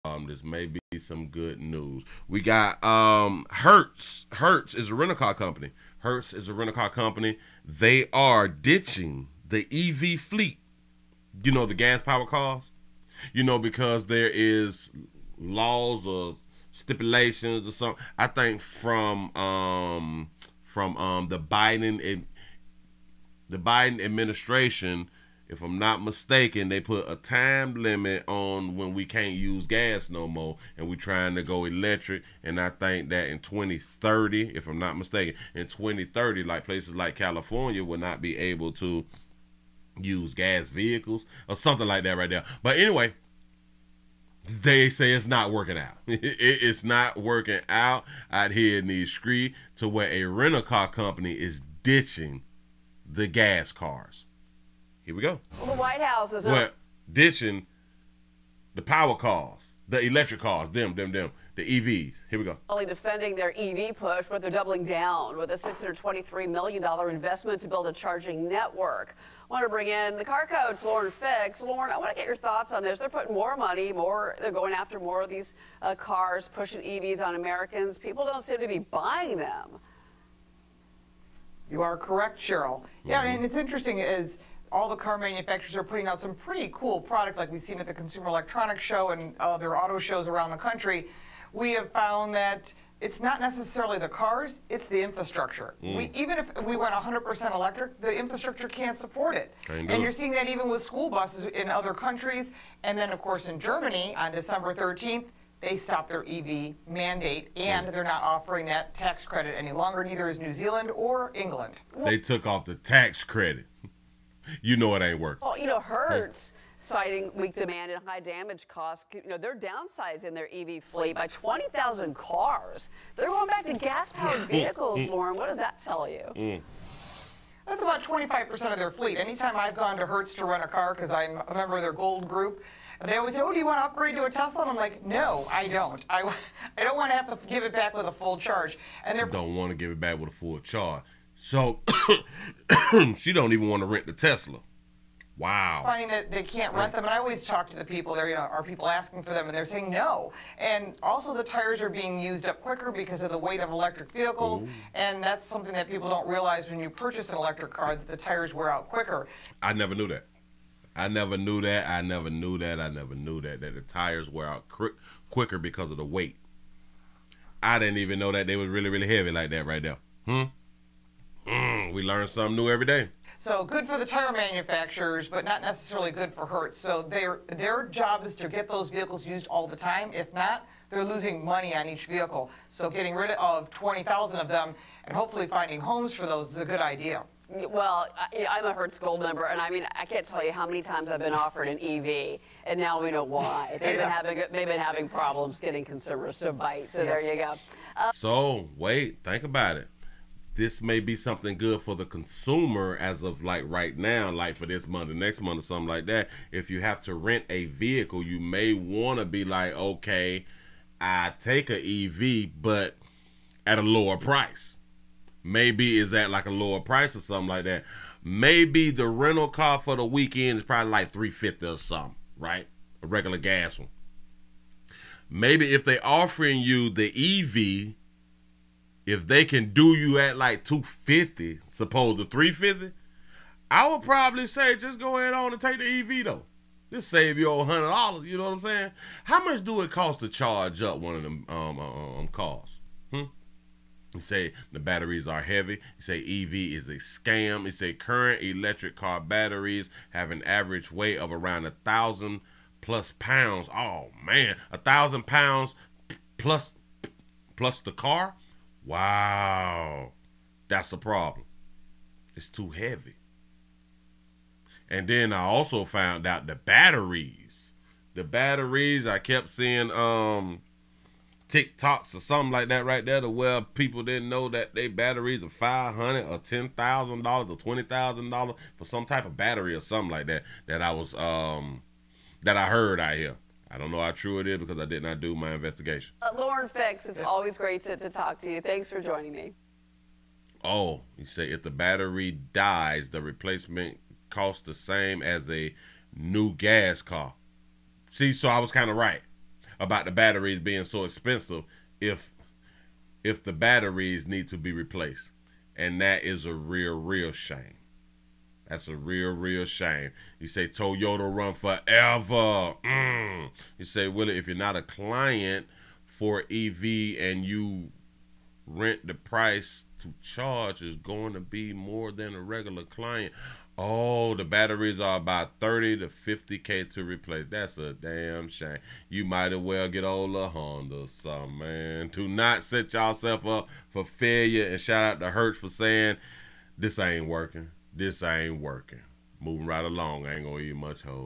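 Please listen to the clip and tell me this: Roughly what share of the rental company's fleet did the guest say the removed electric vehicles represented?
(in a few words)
25%.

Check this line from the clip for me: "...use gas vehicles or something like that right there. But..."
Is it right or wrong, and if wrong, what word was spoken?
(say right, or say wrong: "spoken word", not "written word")
right.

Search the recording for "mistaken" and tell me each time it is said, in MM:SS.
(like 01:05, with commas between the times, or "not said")
00:26, 00:34.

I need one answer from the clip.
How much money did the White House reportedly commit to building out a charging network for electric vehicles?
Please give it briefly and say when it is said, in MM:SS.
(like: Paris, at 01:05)
$623 million, at 01:05.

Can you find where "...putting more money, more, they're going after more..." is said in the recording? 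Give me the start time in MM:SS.
01:13.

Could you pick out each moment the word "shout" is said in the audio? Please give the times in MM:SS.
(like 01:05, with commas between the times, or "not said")
05:34.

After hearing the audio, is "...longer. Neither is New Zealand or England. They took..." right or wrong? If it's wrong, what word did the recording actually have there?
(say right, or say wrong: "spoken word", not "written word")
right.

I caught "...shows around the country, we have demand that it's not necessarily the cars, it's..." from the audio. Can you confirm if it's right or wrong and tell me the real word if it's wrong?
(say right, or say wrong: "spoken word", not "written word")
wrong: "found", not "demand".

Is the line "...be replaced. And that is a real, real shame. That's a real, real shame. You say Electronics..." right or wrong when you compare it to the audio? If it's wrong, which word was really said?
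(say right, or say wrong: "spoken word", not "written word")
wrong: "Toyota", not "Electronics".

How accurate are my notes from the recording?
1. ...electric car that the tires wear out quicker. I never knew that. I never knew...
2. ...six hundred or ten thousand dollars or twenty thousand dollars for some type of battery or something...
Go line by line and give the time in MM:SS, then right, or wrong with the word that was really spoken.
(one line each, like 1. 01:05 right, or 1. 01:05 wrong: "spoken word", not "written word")
1. 02:37 right
2. 04:35 wrong: "five", not "six".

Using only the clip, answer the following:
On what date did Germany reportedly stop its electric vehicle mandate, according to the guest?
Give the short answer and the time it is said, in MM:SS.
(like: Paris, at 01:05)
December 13th, at 01:44.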